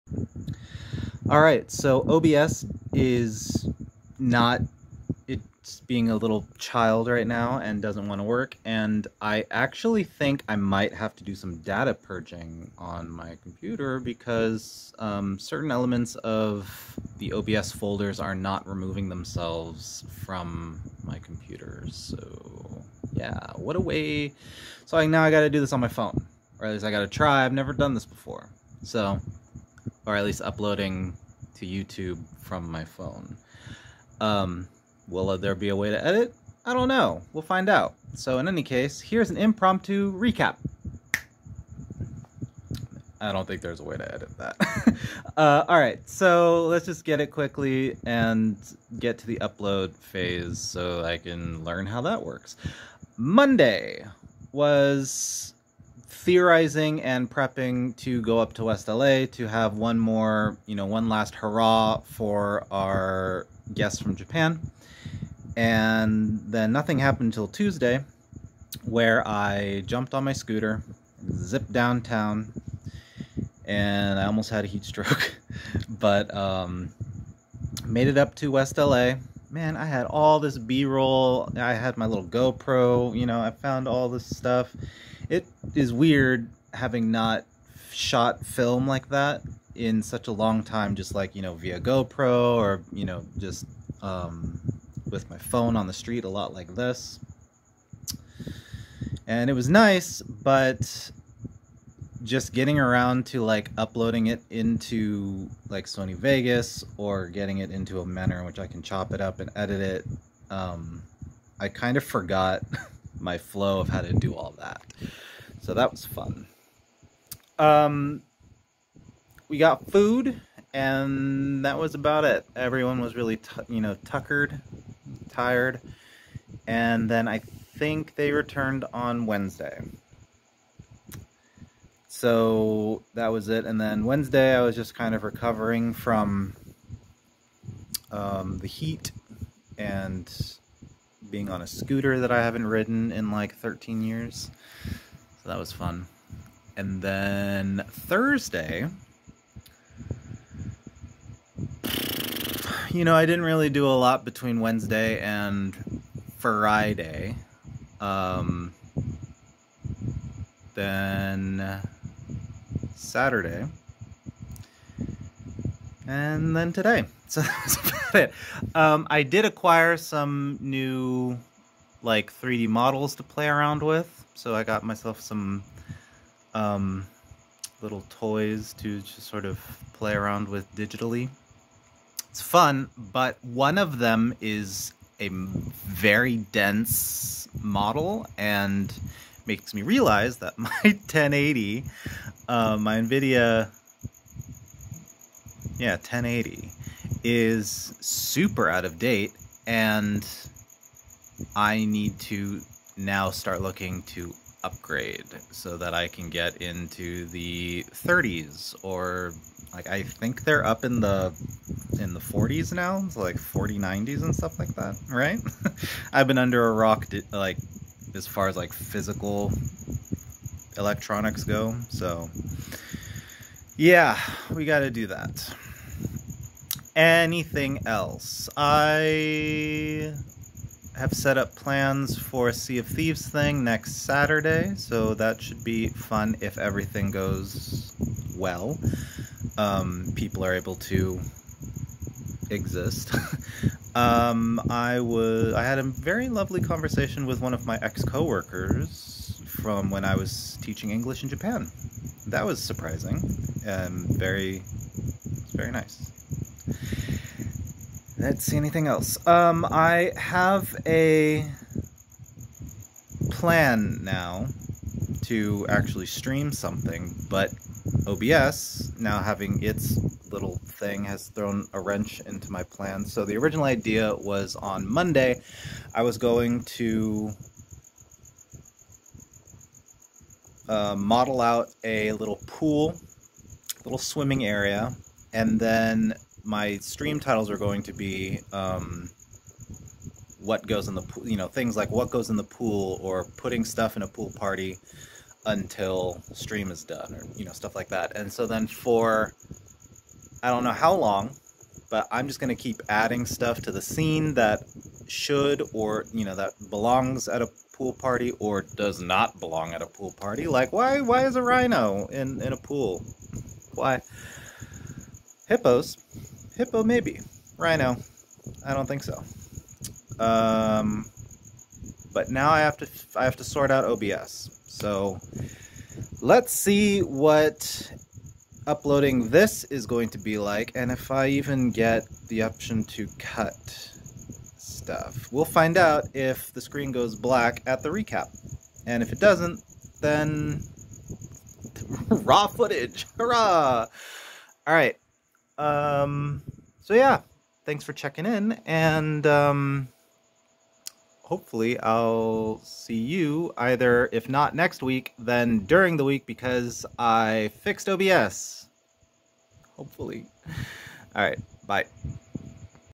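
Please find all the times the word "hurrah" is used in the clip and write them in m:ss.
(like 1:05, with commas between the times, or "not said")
1:01, 5:43.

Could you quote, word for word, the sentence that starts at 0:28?
So or at least uploading to YouTube from my phone.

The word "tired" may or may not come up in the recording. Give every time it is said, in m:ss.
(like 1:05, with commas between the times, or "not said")
2:05.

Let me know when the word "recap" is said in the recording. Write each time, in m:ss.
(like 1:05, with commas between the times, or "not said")
0:40, 5:37.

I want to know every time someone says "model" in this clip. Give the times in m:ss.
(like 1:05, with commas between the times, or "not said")
2:52, 3:07, 4:40.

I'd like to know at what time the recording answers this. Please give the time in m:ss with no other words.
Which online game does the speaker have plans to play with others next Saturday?
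3:52.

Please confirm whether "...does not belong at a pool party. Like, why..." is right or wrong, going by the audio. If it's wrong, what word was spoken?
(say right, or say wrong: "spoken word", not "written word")
right.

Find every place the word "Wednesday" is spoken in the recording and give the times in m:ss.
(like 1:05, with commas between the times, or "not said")
2:09, 2:14, 2:34.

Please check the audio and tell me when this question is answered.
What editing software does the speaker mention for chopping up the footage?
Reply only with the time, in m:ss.
1:45.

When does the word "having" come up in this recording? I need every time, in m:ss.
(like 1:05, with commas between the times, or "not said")
1:26, 4:29.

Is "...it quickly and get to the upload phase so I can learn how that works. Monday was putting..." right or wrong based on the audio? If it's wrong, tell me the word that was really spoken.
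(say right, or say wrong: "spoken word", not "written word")
wrong: "theorizing", not "putting".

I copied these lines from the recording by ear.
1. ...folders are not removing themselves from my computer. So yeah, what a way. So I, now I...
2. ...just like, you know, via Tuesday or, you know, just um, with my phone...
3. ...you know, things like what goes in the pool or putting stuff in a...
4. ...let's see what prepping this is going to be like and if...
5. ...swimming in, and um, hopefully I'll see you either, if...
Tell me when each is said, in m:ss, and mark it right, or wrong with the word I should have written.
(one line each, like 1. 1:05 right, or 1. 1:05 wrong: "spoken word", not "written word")
1. 0:17 right
2. 1:30 wrong: "GoPro", not "Tuesday"
3. 4:51 right
4. 5:26 wrong: "uploading", not "prepping"
5. 5:47 wrong: "checking", not "swimming".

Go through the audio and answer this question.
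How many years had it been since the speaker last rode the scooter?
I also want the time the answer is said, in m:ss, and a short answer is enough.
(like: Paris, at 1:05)
13, at 2:23.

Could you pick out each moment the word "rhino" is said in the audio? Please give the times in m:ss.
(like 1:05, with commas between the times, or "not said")
5:11, 5:17.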